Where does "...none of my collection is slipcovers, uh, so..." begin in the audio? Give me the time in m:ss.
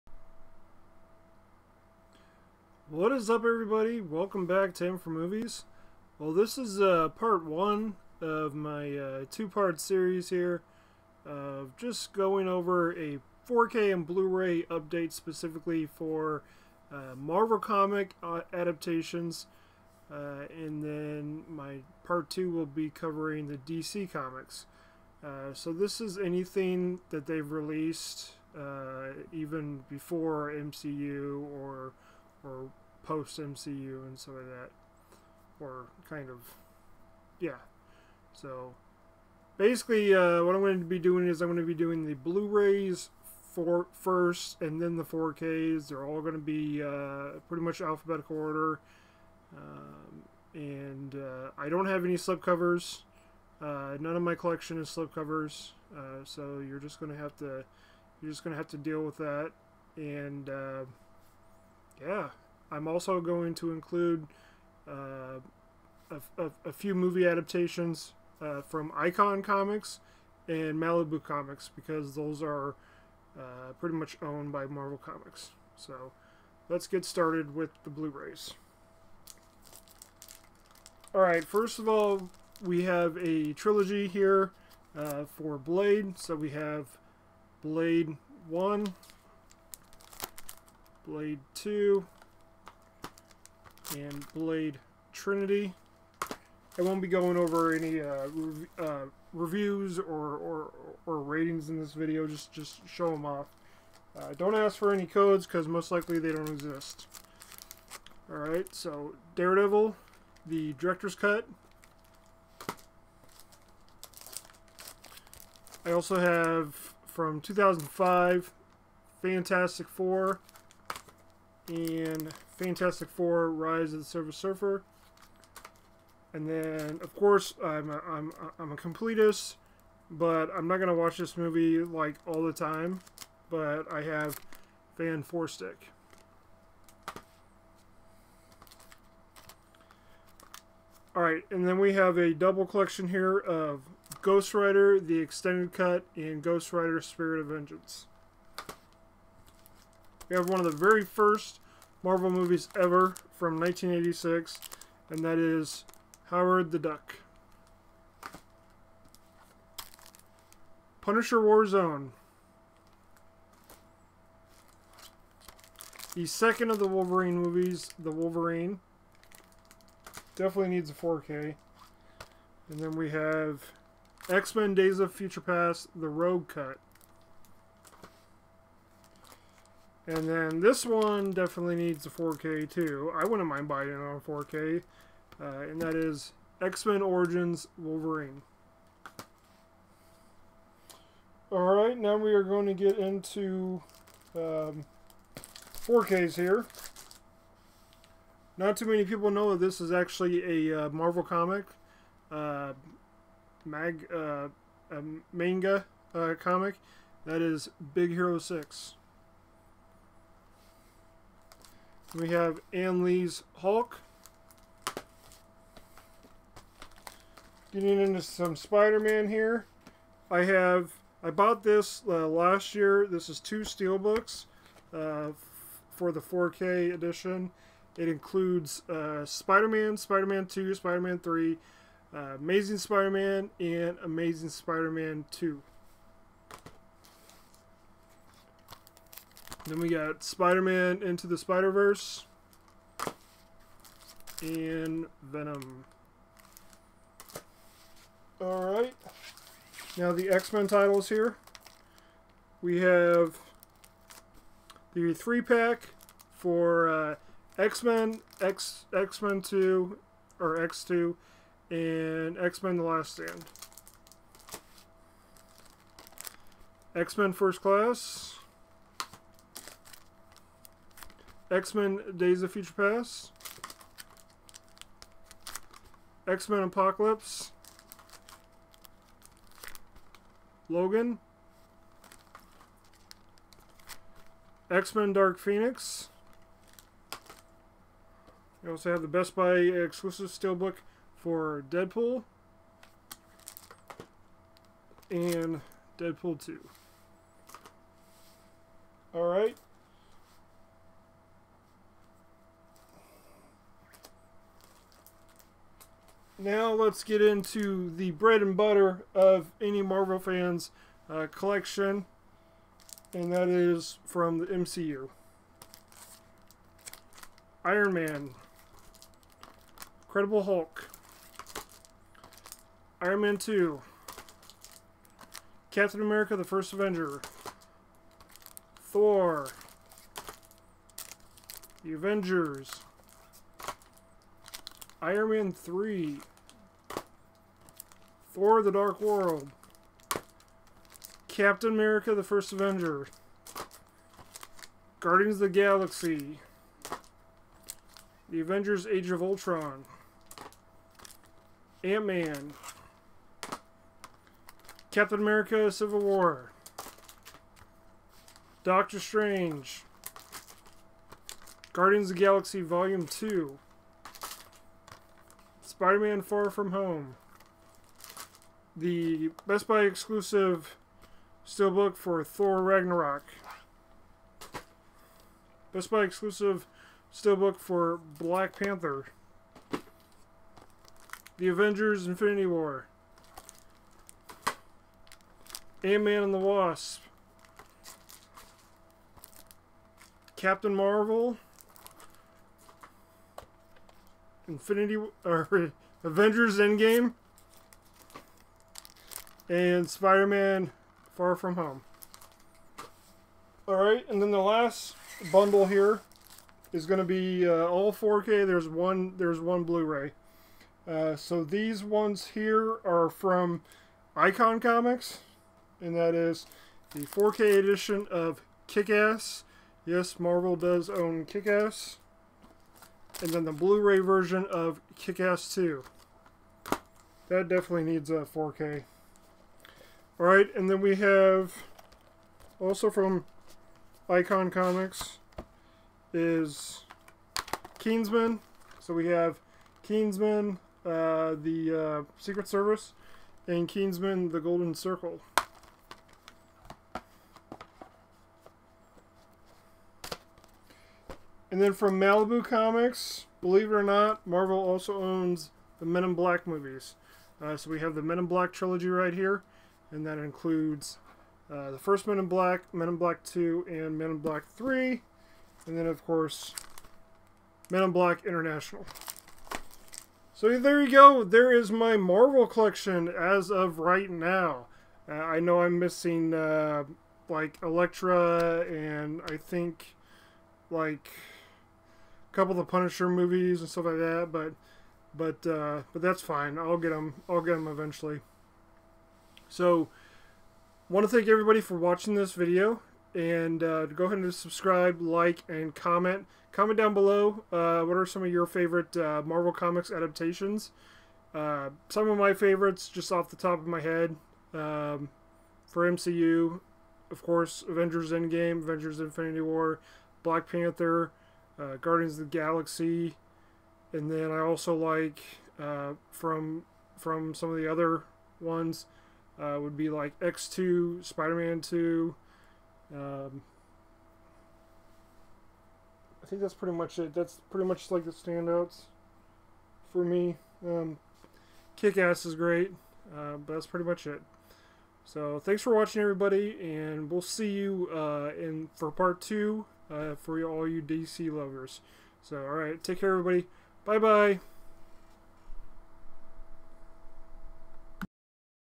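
0:53.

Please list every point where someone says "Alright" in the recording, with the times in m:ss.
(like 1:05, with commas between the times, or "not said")
1:21, 1:48, 3:11, 4:08, 4:59, 6:43.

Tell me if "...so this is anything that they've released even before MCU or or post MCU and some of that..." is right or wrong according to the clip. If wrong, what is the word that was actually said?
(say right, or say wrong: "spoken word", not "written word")
right.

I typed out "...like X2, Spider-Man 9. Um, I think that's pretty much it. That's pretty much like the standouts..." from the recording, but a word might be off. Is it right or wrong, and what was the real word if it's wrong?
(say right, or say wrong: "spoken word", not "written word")
wrong: "2", not "9".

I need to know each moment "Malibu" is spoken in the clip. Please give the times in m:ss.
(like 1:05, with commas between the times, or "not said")
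1:10, 7:31.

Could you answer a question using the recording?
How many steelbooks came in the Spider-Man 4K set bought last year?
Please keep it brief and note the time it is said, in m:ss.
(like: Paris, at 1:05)
2, at 3:43.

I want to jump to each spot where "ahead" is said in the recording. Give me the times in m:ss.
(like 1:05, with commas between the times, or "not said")
8:14.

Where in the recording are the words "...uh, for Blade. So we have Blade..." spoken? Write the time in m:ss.
1:24.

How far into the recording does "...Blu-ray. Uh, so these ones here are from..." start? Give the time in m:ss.
6:49.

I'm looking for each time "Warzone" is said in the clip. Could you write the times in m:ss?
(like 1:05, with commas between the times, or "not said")
2:41.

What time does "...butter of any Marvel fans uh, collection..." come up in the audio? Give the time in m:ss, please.
5:08.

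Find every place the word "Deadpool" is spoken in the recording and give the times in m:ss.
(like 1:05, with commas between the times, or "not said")
4:51, 4:55.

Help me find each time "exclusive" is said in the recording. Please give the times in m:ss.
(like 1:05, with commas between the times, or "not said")
4:49, 6:09, 6:16.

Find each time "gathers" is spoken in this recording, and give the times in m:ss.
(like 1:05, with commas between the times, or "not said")
not said.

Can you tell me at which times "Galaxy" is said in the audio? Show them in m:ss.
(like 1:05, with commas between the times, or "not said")
5:45, 6:02, 8:32.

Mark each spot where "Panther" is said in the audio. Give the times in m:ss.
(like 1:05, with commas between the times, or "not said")
6:18, 8:30.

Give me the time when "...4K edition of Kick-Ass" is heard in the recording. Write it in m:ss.
6:57.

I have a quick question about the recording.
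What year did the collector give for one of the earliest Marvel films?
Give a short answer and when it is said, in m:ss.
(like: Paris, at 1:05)
1986, at 2:33.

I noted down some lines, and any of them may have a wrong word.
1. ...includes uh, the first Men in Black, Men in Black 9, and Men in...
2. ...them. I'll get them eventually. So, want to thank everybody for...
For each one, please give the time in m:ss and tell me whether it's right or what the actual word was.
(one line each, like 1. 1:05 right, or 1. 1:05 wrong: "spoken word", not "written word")
1. 7:40 wrong: "2", not "9"
2. 8:06 right.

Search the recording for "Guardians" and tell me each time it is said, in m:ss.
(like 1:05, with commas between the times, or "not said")
5:45, 6:01, 8:31.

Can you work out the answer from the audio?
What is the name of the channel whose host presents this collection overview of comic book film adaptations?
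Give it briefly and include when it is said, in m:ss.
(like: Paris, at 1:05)
M for Movies, at 0:04.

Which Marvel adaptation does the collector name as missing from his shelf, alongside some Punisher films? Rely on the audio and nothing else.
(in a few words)
Elektra.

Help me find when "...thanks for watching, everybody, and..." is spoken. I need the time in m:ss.
8:55.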